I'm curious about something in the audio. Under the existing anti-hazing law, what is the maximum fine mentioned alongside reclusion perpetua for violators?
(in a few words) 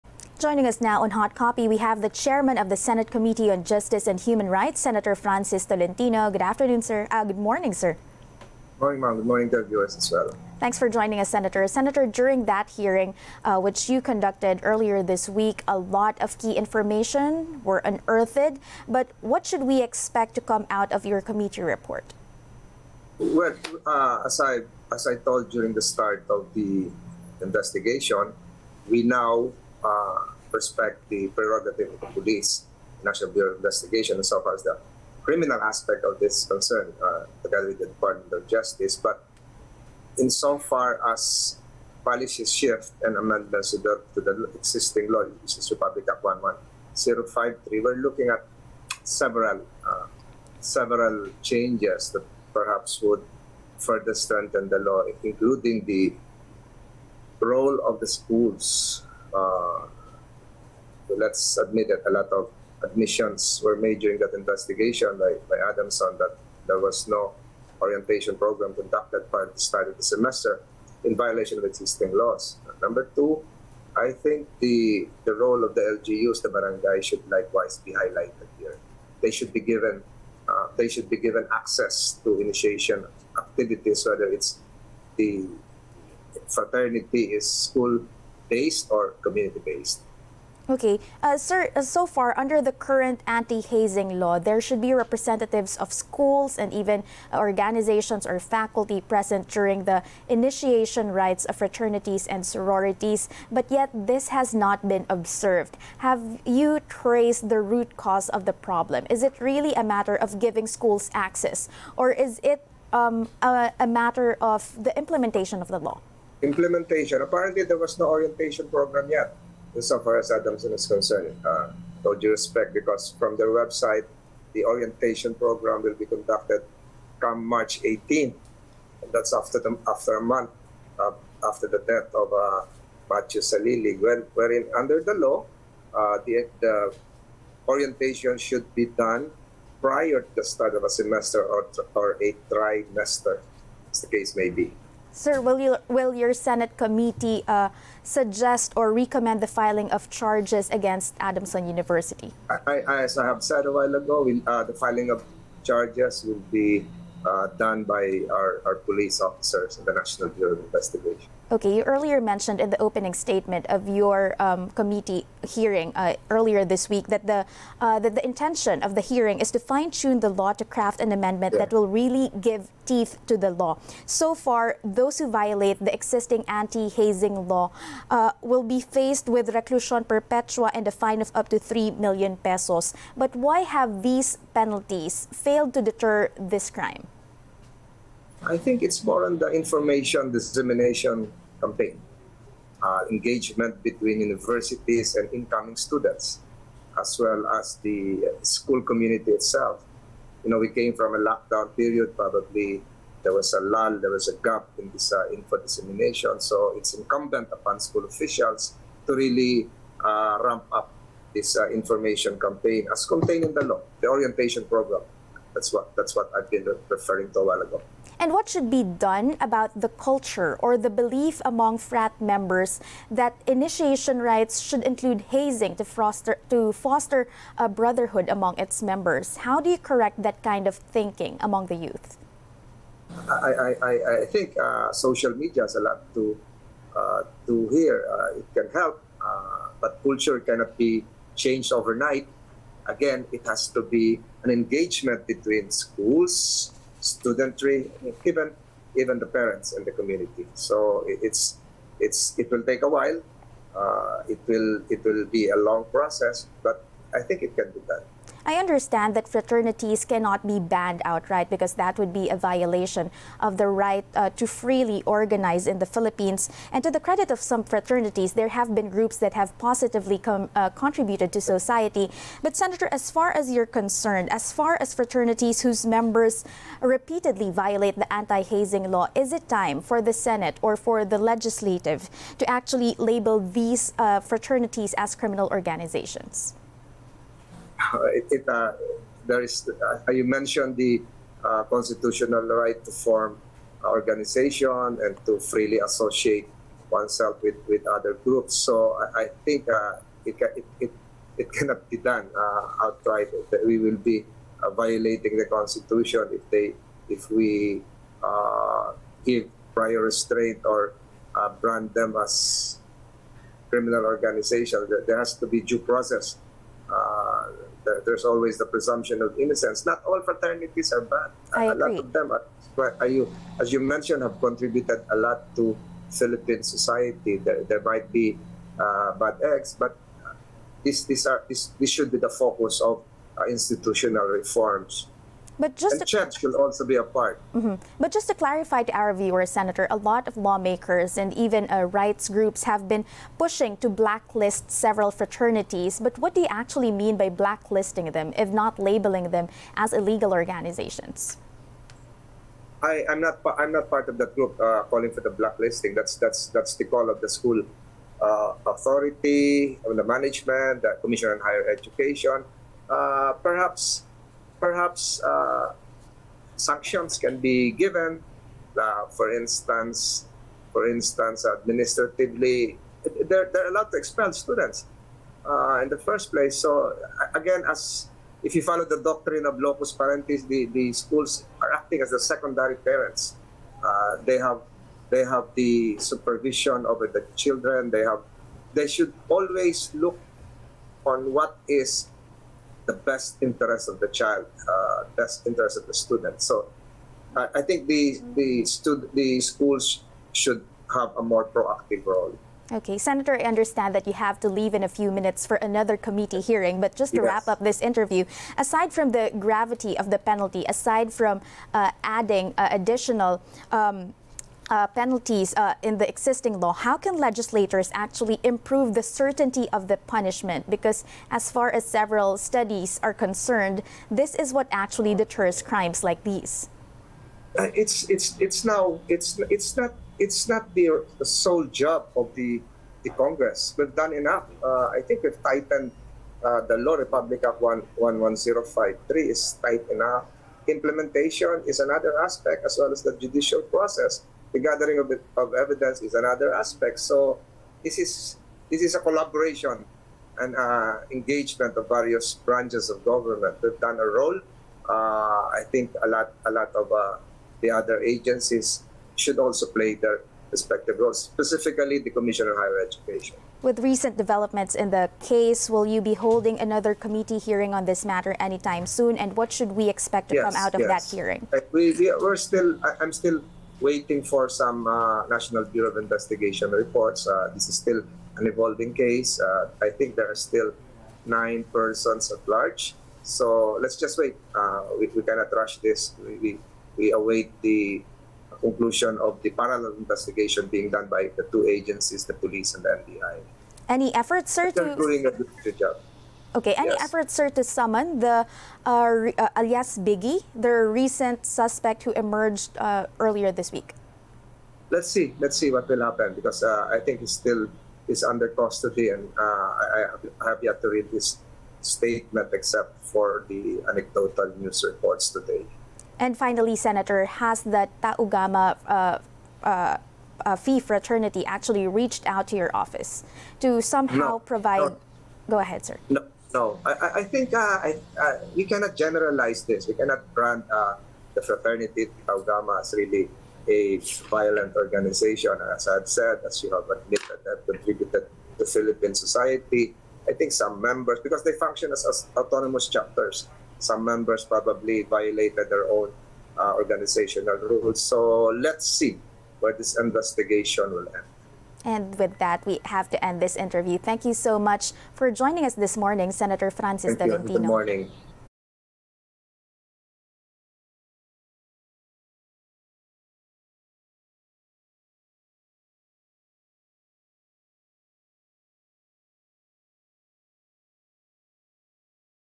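3 million pesos.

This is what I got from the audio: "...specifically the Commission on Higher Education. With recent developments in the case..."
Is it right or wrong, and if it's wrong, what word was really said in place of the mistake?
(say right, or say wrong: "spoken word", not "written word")
right.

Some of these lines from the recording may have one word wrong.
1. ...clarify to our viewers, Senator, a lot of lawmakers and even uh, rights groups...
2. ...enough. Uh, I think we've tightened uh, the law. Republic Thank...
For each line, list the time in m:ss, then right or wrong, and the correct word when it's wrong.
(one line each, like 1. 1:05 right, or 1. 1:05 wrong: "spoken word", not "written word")
1. 5:38 right
2. 7:14 wrong: "Act", not "Thank".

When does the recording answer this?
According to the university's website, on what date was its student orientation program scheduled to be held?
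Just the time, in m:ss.
2:07.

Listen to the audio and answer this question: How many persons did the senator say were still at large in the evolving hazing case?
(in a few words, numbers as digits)
9.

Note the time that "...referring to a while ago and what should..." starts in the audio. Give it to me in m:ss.
3:36.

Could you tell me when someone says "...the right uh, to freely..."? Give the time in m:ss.
4:23.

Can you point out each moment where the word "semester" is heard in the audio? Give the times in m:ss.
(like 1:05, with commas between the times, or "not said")
1:10, 2:20.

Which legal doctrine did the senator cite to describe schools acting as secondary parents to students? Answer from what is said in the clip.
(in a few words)
locus parentis.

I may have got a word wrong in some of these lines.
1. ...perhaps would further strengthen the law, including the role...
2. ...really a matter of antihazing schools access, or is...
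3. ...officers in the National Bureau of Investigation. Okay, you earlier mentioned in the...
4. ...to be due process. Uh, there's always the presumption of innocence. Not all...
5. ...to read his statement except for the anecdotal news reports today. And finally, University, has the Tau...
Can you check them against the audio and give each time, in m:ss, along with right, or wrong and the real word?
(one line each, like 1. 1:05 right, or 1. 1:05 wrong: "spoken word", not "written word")
1. 0:52 right
2. 1:49 wrong: "giving", not "antihazing"
3. 2:39 right
4. 5:15 right
5. 8:30 wrong: "Senator", not "University".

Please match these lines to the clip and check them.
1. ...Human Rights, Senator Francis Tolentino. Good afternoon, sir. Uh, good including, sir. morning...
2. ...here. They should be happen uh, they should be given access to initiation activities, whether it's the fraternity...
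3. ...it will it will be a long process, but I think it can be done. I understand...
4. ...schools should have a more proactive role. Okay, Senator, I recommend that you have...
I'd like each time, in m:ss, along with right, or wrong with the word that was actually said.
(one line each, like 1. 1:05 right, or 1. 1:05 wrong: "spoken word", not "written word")
1. 0:04 wrong: "morning", not "including"
2. 1:18 wrong: "given", not "happen"
3. 4:14 right
4. 6:39 wrong: "understand", not "recommend".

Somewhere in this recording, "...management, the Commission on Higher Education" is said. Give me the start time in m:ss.
6:00.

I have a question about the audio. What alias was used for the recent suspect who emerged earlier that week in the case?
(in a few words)
Biggie.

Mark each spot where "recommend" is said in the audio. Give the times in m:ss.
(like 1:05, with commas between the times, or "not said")
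2:28.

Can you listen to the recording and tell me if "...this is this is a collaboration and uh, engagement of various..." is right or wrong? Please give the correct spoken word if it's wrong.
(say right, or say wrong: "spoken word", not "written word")
right.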